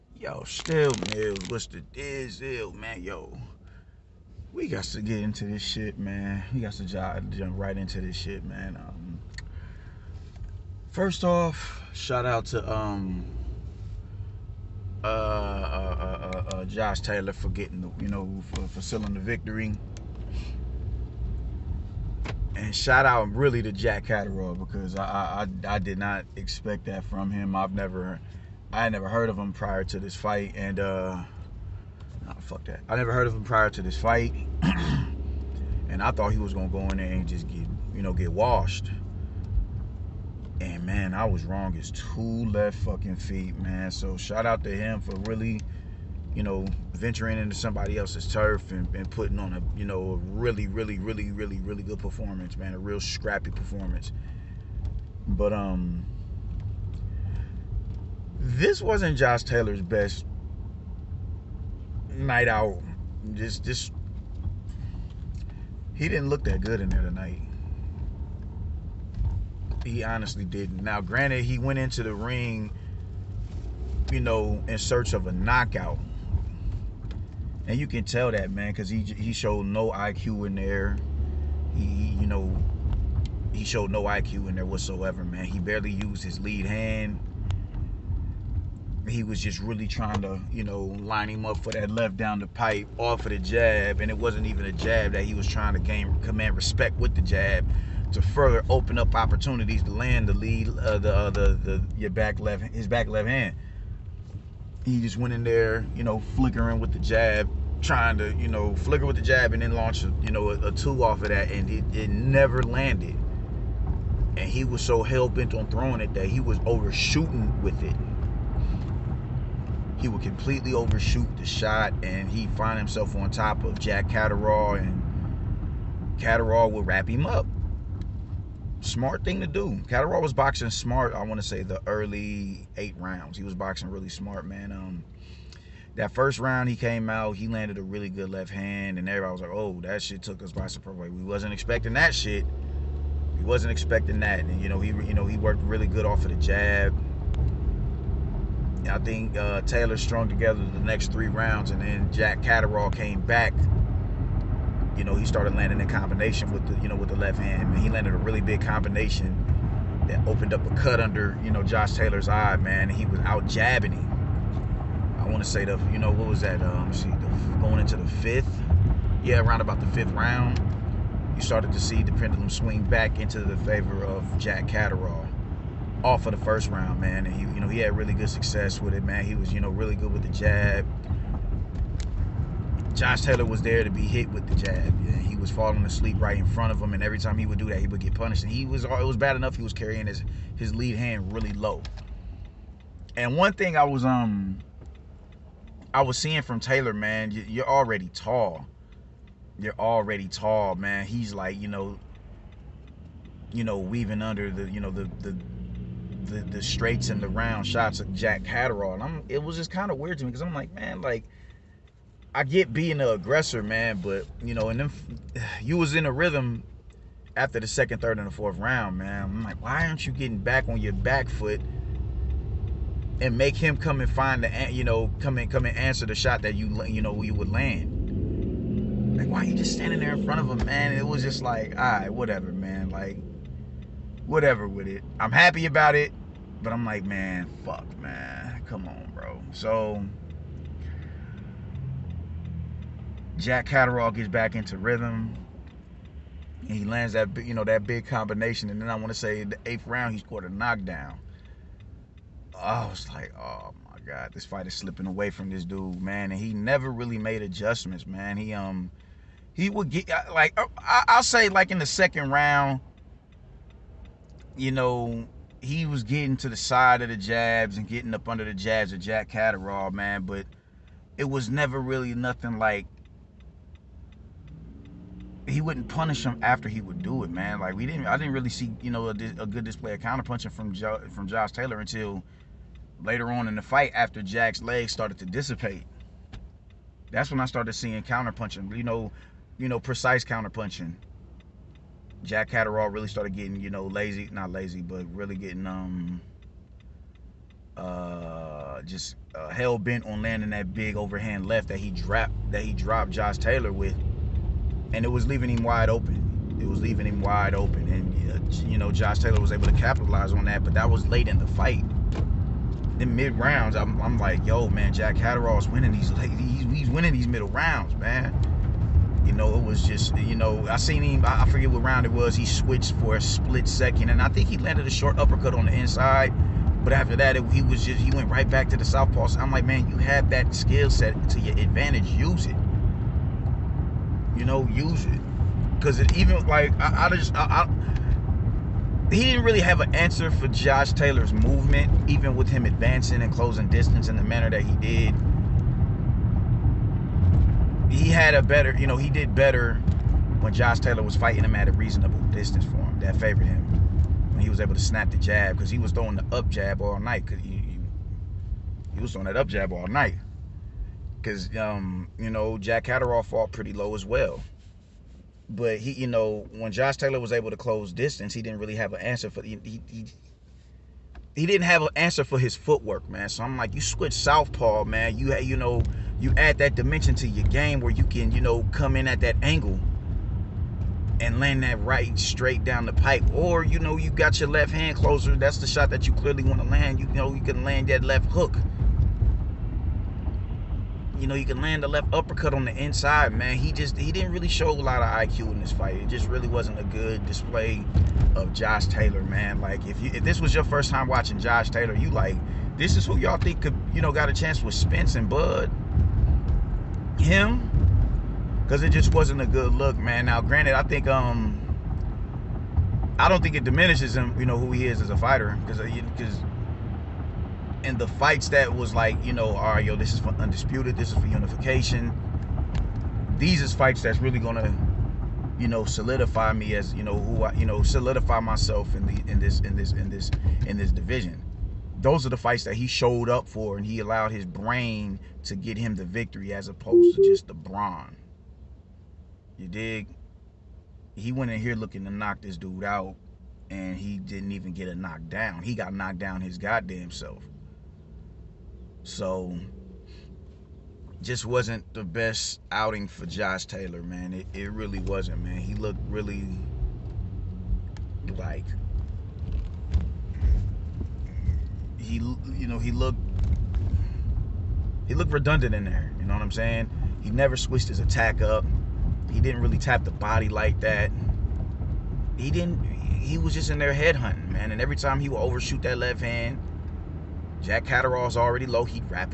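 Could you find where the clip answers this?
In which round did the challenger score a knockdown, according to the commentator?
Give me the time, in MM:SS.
04:09.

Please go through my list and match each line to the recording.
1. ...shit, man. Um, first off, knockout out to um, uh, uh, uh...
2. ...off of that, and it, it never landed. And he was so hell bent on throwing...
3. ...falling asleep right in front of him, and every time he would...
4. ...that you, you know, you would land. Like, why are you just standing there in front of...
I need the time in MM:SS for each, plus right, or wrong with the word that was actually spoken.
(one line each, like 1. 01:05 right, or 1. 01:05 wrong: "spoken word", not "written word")
1. 00:08 wrong: "shout", not "knockout"
2. 01:51 right
3. 03:05 right
4. 03:46 right.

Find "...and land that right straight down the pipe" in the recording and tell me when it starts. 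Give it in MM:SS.
06:21.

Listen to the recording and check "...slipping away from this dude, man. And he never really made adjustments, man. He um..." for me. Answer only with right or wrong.
right.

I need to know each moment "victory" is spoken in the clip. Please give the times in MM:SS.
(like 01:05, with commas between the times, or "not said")
00:19, 07:16.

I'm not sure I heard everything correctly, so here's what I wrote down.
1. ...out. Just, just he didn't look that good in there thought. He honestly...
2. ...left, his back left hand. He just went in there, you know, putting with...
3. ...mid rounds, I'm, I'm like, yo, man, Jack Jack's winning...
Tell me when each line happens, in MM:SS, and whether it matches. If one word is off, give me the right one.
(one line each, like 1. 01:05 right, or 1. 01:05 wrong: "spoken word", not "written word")
1. 01:02 wrong: "tonight", not "thought"
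2. 01:42 wrong: "flickering", not "putting"
3. 05:13 wrong: "Catterall", not "Jack".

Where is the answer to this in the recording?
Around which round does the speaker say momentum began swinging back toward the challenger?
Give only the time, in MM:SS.
02:49.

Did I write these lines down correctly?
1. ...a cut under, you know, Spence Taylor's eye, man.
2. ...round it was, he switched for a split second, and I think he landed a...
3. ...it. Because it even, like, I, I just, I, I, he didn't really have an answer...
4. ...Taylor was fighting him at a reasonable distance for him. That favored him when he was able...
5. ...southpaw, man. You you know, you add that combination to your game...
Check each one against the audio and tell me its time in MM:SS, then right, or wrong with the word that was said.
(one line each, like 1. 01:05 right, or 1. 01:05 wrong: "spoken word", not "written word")
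1. 02:40 wrong: "Josh", not "Spence"
2. 05:21 right
3. 05:35 right
4. 05:50 right
5. 06:14 wrong: "dimension", not "combination".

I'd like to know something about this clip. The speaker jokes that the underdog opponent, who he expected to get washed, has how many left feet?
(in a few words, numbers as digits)
2.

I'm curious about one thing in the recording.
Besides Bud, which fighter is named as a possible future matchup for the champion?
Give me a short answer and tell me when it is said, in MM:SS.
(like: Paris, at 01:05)
Spence, at 06:44.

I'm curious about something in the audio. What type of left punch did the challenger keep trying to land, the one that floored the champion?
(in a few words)
Overhand left.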